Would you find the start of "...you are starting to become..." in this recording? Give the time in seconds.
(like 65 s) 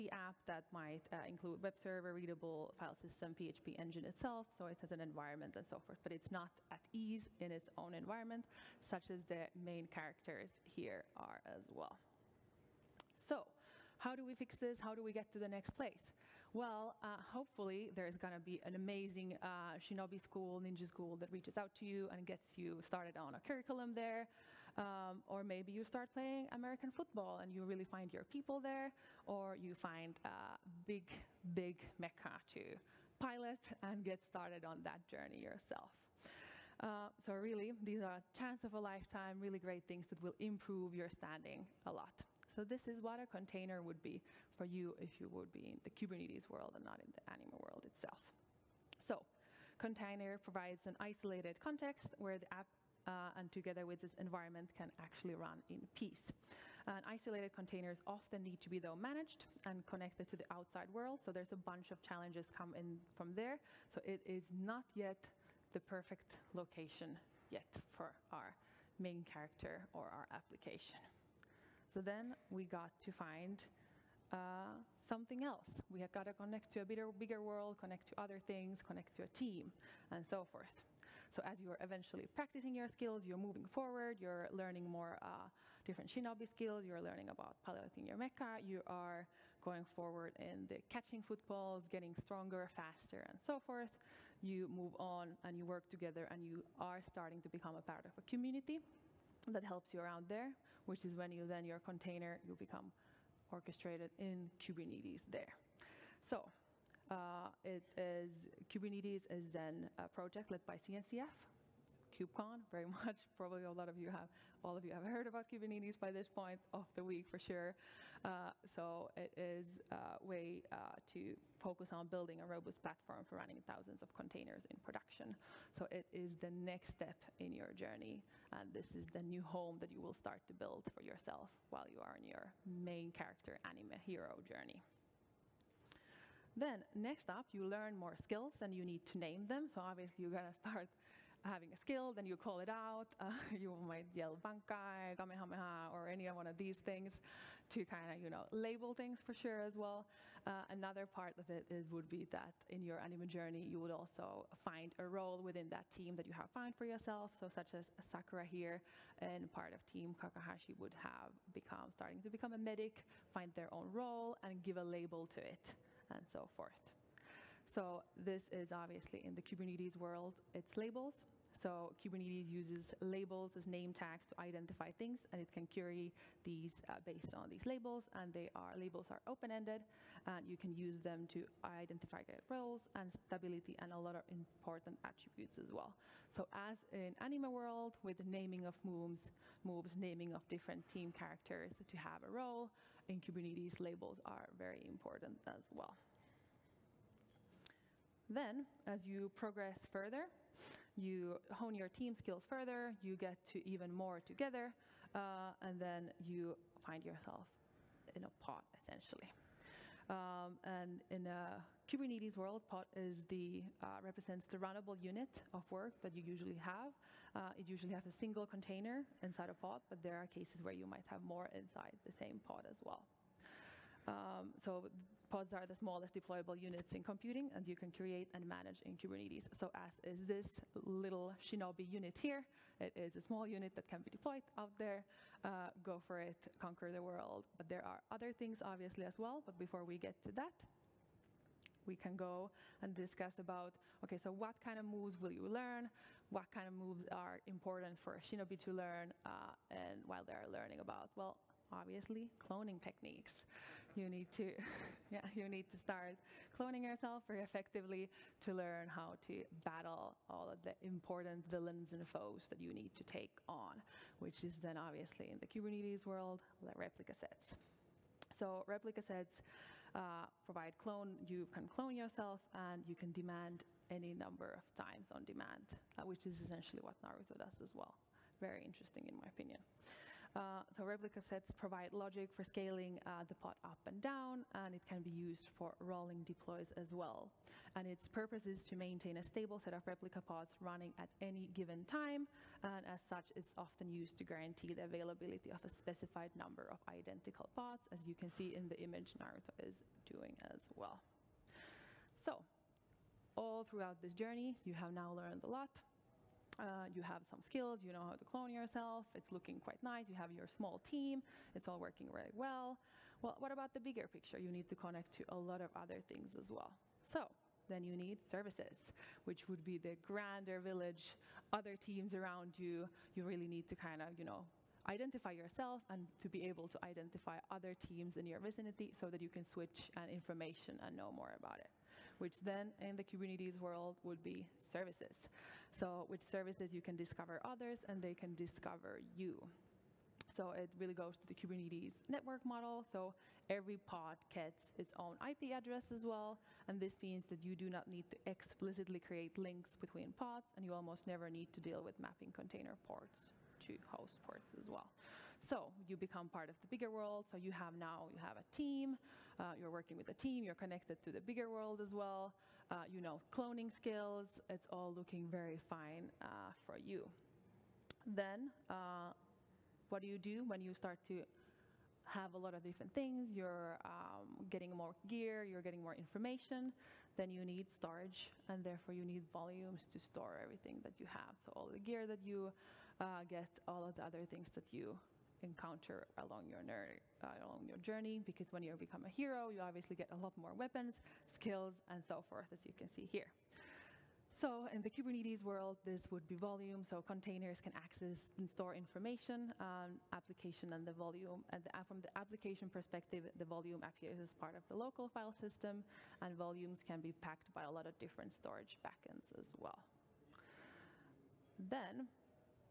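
96 s.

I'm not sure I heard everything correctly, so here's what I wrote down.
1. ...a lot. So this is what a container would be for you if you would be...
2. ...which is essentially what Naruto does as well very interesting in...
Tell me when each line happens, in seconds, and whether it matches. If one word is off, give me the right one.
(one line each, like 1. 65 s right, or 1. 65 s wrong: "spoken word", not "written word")
1. 41 s right
2. 276 s right.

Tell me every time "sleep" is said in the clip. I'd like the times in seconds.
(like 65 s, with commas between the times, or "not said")
not said.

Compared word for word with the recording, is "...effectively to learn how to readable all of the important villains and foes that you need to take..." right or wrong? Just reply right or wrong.
wrong.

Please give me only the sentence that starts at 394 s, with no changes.
So in the Kubernetes world, this would be volume.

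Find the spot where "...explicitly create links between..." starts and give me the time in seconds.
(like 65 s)
348 s.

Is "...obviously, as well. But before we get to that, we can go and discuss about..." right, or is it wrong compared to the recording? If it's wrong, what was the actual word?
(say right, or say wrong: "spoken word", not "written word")
right.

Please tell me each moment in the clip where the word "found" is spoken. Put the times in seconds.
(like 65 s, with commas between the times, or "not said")
156 s.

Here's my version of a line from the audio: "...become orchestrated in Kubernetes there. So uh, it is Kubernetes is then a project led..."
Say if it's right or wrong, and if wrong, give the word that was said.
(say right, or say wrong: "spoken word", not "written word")
right.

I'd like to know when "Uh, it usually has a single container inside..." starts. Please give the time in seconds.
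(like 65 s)
217 s.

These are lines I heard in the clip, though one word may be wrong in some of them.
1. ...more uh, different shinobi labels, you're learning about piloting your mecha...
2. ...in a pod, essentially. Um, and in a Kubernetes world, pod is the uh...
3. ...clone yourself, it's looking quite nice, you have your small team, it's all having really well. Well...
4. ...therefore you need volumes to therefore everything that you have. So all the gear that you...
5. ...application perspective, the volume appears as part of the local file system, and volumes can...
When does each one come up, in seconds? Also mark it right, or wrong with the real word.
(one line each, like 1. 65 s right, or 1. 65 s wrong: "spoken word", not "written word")
1. 84 s wrong: "skills", not "labels"
2. 208 s right
3. 308 s wrong: "working", not "having"
4. 378 s wrong: "store", not "therefore"
5. 402 s right.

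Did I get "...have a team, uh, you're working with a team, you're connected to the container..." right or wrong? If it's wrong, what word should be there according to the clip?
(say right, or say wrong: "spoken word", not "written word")
wrong: "bigger", not "container".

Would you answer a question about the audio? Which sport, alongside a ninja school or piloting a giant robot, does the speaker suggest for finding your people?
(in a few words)
American football.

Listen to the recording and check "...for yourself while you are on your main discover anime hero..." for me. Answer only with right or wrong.
wrong.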